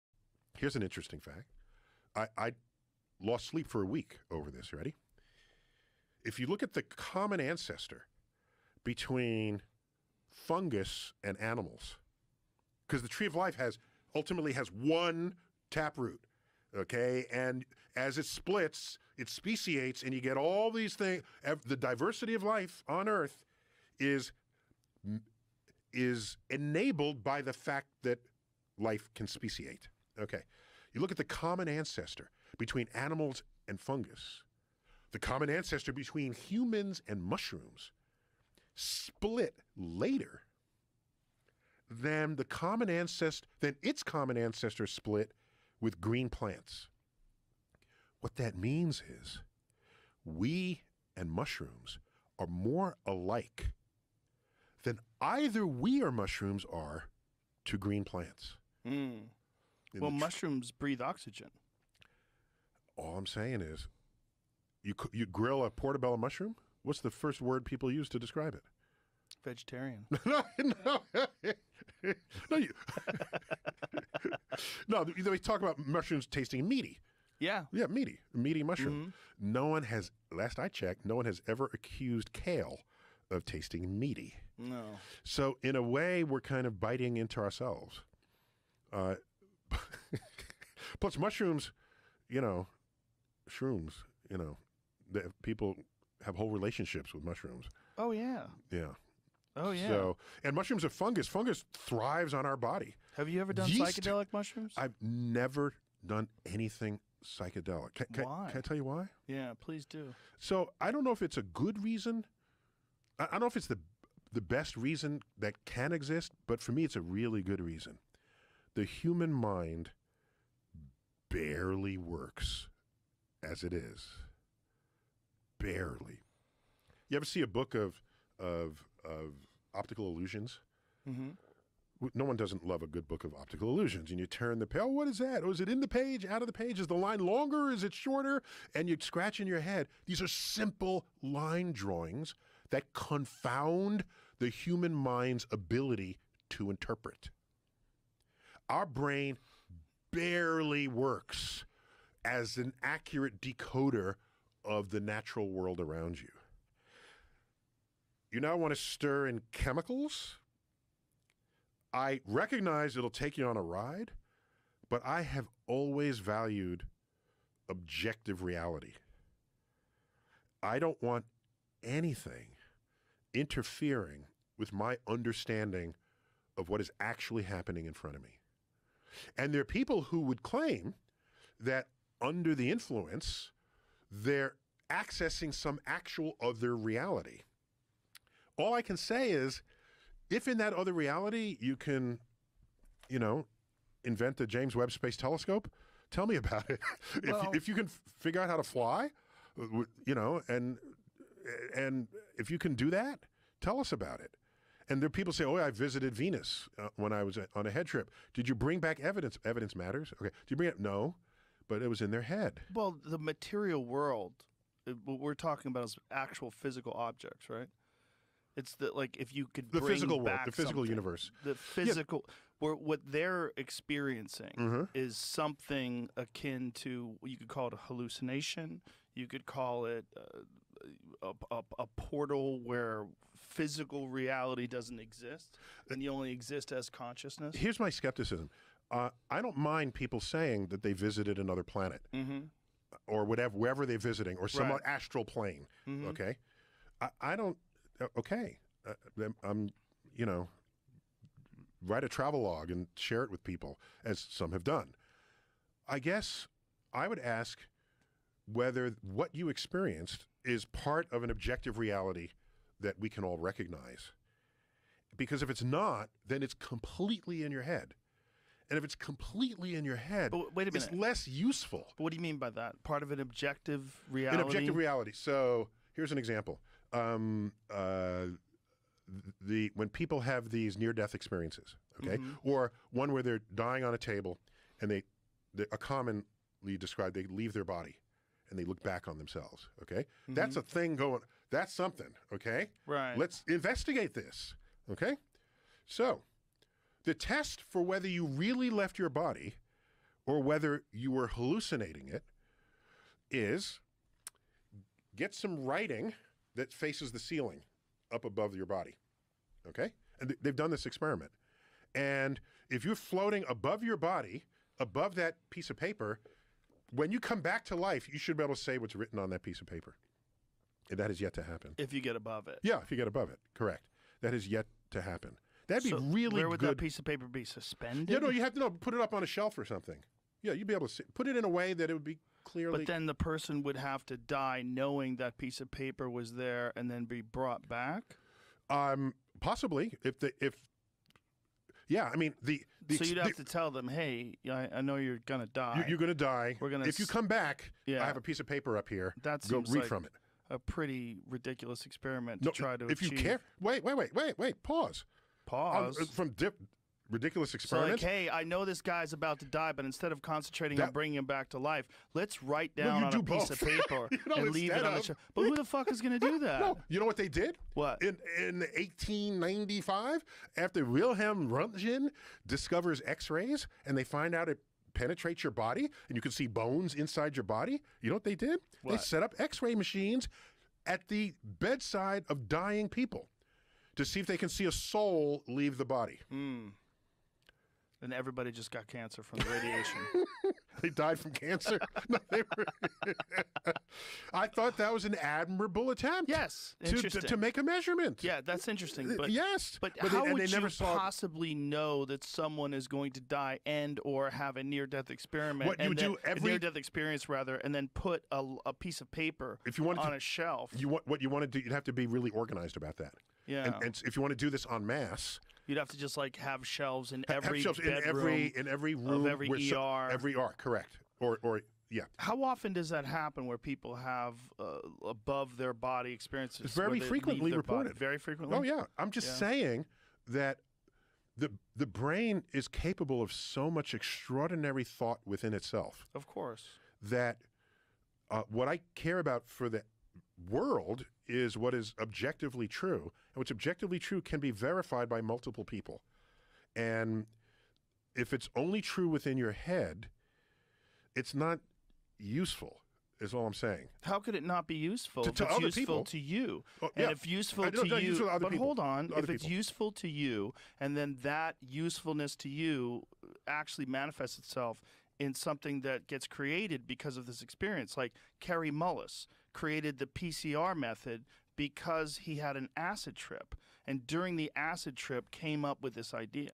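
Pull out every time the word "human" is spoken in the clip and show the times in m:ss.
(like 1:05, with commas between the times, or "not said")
0:36, 1:58, 2:24.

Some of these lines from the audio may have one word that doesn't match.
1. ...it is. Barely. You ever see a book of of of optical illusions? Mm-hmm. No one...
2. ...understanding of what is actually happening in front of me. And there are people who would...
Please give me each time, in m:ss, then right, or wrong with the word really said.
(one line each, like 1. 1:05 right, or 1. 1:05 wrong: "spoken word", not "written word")
1. 2:03 right
2. 2:55 right.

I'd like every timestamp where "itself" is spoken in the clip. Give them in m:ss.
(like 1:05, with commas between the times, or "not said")
7:15, 7:44.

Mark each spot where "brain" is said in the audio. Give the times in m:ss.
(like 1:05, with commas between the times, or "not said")
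2:28, 7:11.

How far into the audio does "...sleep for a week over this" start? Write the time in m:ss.
0:03.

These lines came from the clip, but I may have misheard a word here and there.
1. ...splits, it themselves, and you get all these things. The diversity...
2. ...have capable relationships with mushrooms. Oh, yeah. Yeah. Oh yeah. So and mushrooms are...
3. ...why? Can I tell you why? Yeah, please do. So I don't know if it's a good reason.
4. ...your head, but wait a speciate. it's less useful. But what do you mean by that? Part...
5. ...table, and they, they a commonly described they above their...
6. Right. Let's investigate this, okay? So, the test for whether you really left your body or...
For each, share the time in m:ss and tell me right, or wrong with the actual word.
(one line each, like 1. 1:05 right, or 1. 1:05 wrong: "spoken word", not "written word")
1. 0:18 wrong: "speciates", not "themselves"
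2. 1:36 wrong: "whole", not "capable"
3. 1:48 right
4. 4:29 wrong: "minute", not "speciate"
5. 4:43 wrong: "leave", not "above"
6. 4:52 right.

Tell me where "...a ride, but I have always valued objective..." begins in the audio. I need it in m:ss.
2:43.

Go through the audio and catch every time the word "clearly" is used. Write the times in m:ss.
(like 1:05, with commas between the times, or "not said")
5:32.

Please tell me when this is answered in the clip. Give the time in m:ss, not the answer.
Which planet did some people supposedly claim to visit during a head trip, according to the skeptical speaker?
3:26.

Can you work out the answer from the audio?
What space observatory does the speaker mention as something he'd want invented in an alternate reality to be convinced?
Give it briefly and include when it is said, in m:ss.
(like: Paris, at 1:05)
James Webb Space Telescope, at 3:14.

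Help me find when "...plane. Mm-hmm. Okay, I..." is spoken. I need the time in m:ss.
4:05.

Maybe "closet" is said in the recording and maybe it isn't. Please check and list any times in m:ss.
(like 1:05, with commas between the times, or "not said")
not said.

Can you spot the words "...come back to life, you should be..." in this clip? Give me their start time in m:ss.
5:17.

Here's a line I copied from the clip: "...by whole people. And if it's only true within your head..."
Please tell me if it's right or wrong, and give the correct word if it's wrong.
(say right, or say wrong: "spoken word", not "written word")
wrong: "multiple", not "whole".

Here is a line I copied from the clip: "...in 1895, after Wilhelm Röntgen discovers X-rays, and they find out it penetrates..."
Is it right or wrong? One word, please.
right.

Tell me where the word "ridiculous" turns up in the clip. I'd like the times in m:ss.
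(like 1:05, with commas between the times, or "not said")
5:51, 5:57.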